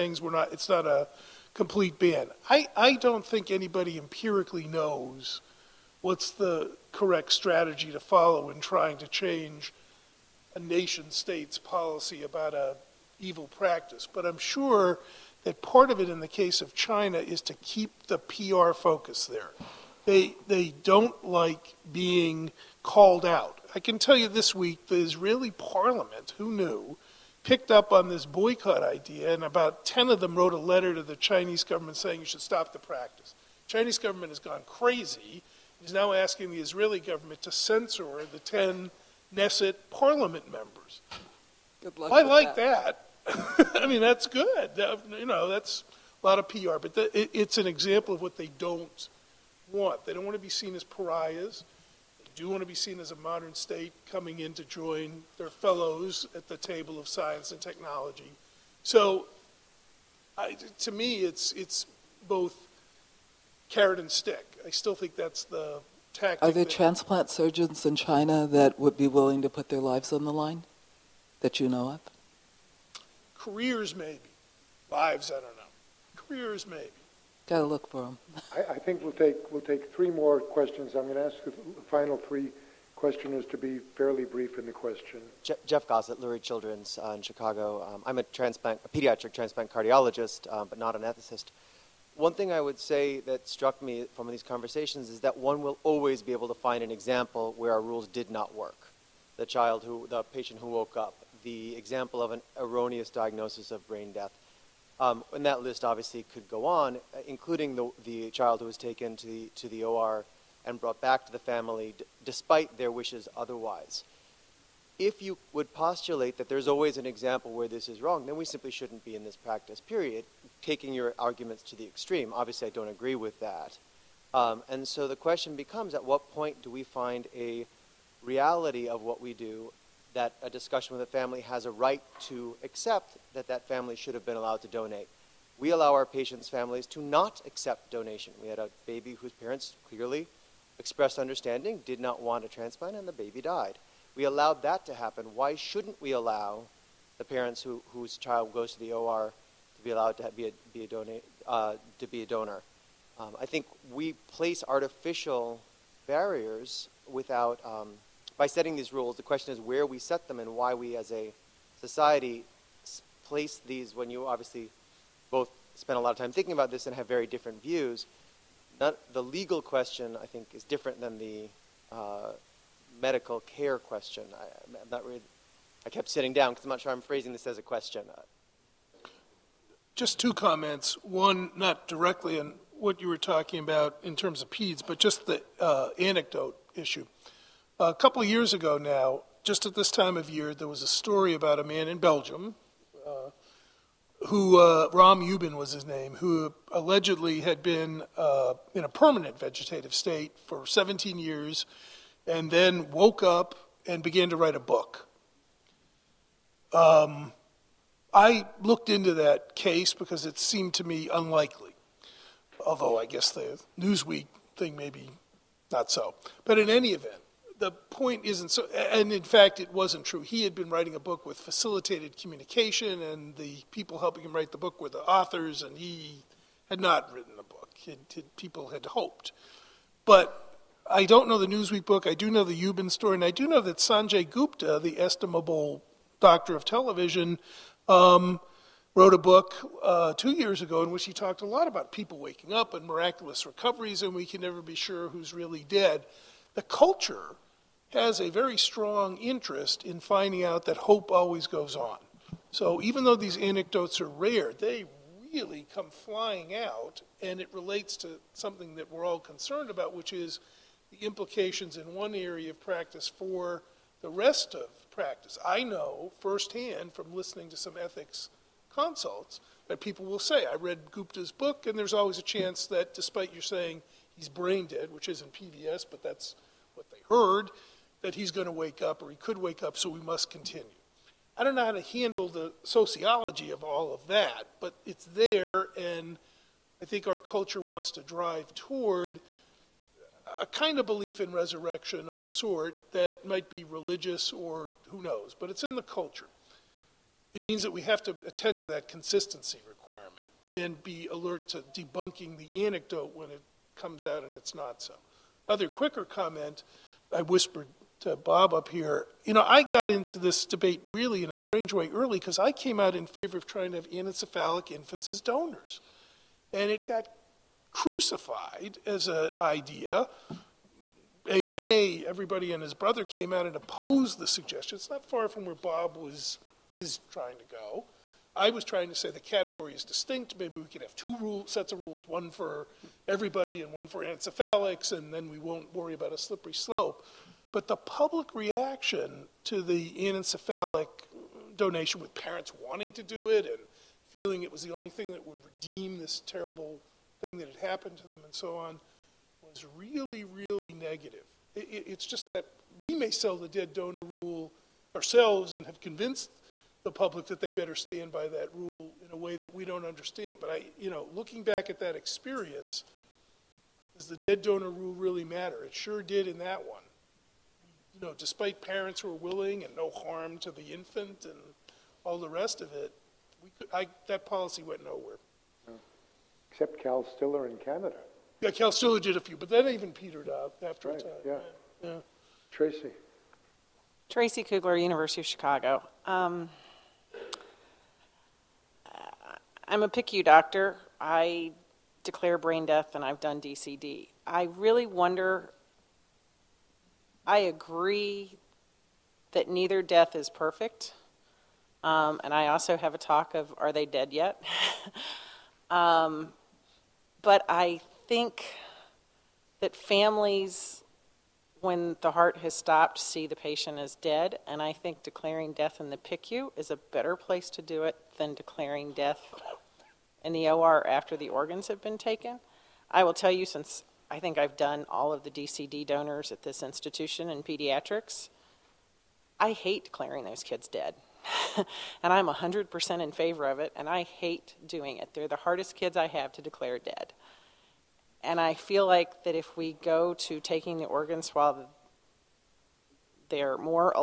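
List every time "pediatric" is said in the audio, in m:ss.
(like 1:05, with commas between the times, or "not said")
1:28, 7:07.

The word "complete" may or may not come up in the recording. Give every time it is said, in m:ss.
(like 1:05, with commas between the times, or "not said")
0:01.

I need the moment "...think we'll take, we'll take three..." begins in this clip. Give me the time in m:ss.
1:18.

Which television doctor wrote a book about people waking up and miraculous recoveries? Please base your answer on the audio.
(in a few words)
Sanjay Gupta.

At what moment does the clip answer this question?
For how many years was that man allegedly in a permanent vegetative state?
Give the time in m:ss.
3:20.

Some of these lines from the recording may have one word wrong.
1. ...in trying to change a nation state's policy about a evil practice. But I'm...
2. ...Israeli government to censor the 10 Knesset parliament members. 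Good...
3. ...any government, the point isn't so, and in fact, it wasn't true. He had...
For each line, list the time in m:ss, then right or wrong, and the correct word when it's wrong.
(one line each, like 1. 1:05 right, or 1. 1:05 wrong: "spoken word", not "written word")
1. 0:08 right
2. 0:36 right
3. 3:36 wrong: "event", not "government".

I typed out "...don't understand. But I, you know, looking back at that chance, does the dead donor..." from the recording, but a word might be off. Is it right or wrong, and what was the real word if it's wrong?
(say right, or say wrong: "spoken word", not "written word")
wrong: "experience", not "chance".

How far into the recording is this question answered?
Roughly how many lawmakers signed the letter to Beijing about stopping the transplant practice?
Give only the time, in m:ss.
0:29.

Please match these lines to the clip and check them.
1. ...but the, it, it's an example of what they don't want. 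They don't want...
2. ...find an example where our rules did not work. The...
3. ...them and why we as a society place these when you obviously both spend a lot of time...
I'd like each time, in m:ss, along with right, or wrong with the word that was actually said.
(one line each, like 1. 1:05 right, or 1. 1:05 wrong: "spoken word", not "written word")
1. 0:46 right
2. 1:36 right
3. 2:40 right.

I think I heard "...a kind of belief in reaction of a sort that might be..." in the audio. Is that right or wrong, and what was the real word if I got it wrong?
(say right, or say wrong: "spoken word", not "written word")
wrong: "resurrection", not "reaction".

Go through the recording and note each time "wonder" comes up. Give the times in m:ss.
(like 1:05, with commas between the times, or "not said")
6:34.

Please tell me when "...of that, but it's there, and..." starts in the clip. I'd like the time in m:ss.
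4:43.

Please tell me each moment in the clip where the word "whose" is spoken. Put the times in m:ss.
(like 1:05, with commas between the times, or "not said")
2:19, 2:27.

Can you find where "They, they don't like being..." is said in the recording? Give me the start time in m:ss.
0:20.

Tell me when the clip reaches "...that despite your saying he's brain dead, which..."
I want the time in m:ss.
4:32.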